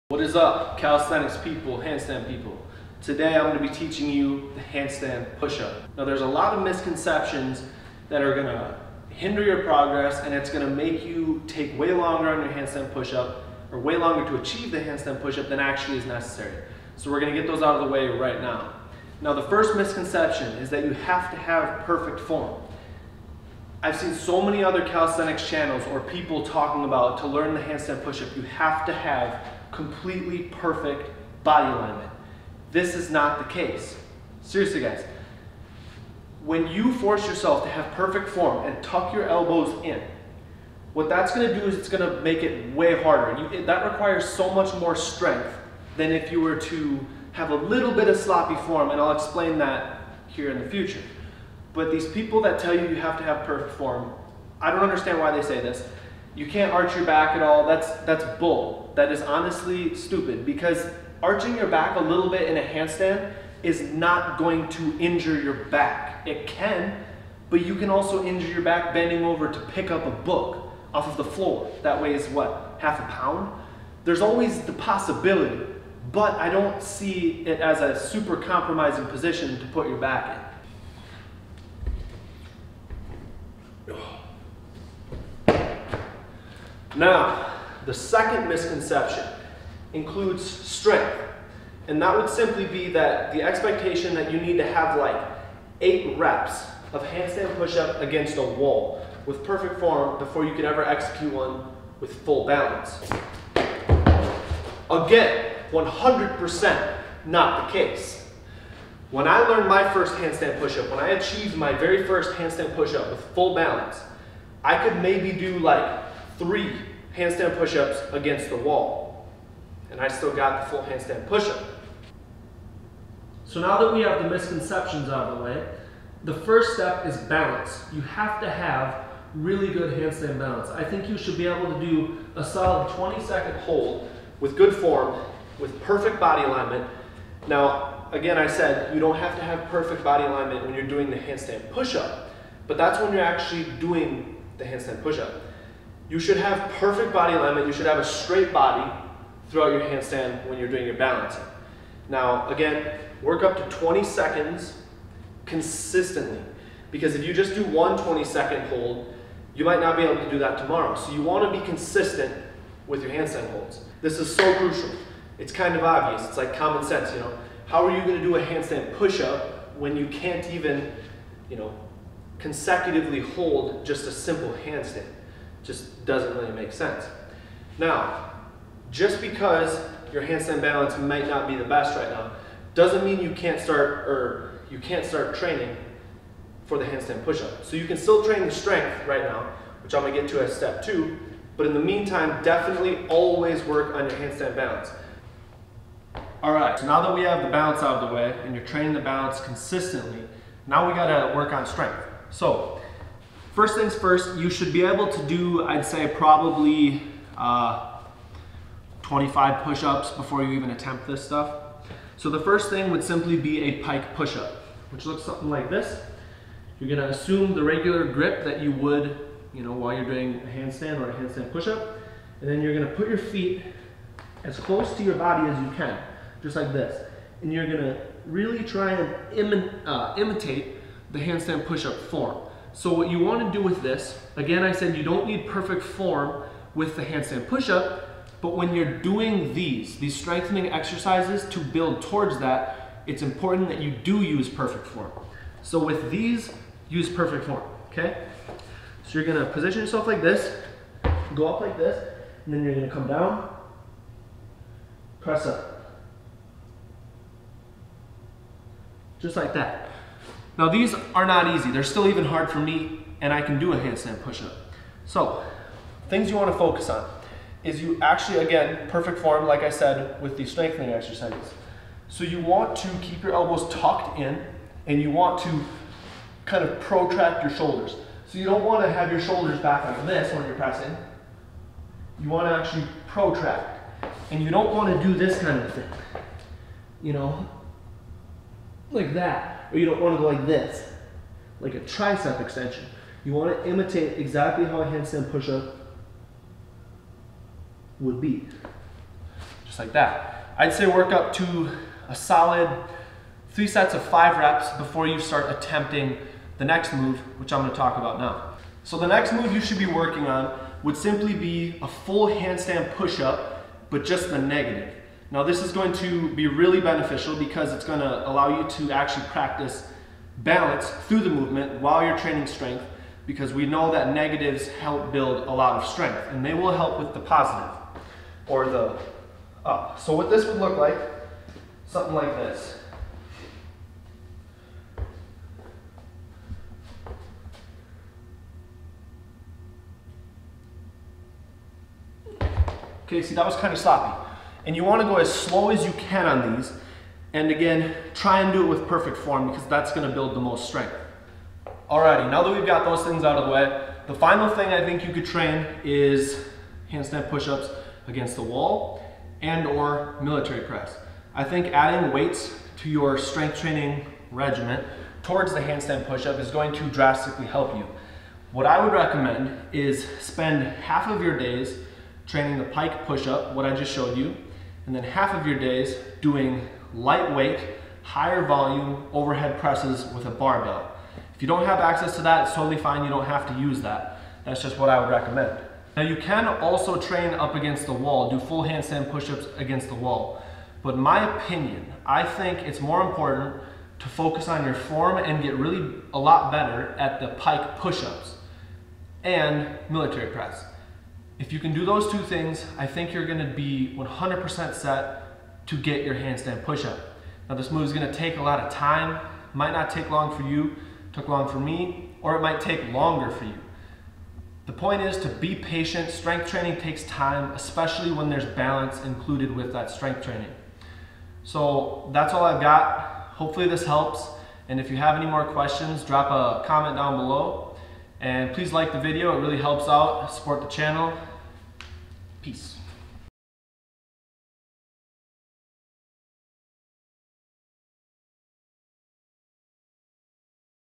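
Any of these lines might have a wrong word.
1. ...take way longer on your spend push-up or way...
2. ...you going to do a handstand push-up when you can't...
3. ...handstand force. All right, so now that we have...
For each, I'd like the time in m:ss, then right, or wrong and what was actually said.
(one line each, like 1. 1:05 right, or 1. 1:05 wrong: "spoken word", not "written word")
1. 0:11 wrong: "handstand", not "spend"
2. 2:47 right
3. 3:14 wrong: "balance", not "force".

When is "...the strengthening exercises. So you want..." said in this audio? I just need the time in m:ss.
4:30.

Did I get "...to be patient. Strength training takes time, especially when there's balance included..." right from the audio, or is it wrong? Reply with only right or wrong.
right.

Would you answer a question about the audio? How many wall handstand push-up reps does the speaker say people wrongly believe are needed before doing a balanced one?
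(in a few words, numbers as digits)
8.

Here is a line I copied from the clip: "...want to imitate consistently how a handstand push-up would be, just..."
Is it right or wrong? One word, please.
wrong.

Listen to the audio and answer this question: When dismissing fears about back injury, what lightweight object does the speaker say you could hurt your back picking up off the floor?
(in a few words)
a book.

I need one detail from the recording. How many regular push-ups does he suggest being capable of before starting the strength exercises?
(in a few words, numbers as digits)
25.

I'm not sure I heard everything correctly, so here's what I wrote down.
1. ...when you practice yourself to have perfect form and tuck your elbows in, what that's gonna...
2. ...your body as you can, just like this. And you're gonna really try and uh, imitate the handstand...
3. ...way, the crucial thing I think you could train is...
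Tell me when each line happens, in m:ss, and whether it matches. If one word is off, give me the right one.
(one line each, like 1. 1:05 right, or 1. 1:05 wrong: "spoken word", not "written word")
1. 0:36 wrong: "force", not "practice"
2. 3:45 right
3. 5:53 wrong: "final", not "crucial".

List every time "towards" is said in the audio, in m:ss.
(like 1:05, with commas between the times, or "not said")
4:02, 6:05.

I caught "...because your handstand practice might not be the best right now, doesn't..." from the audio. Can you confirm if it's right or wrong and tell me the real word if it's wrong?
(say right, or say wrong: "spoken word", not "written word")
wrong: "balance", not "practice".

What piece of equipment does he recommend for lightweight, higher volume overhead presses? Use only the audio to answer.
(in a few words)
barbell.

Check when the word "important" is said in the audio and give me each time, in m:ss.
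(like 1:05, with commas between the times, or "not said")
4:03, 6:33.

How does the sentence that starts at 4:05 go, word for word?
So with these, use perfect form, okay?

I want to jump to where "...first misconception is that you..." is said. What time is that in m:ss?
0:19.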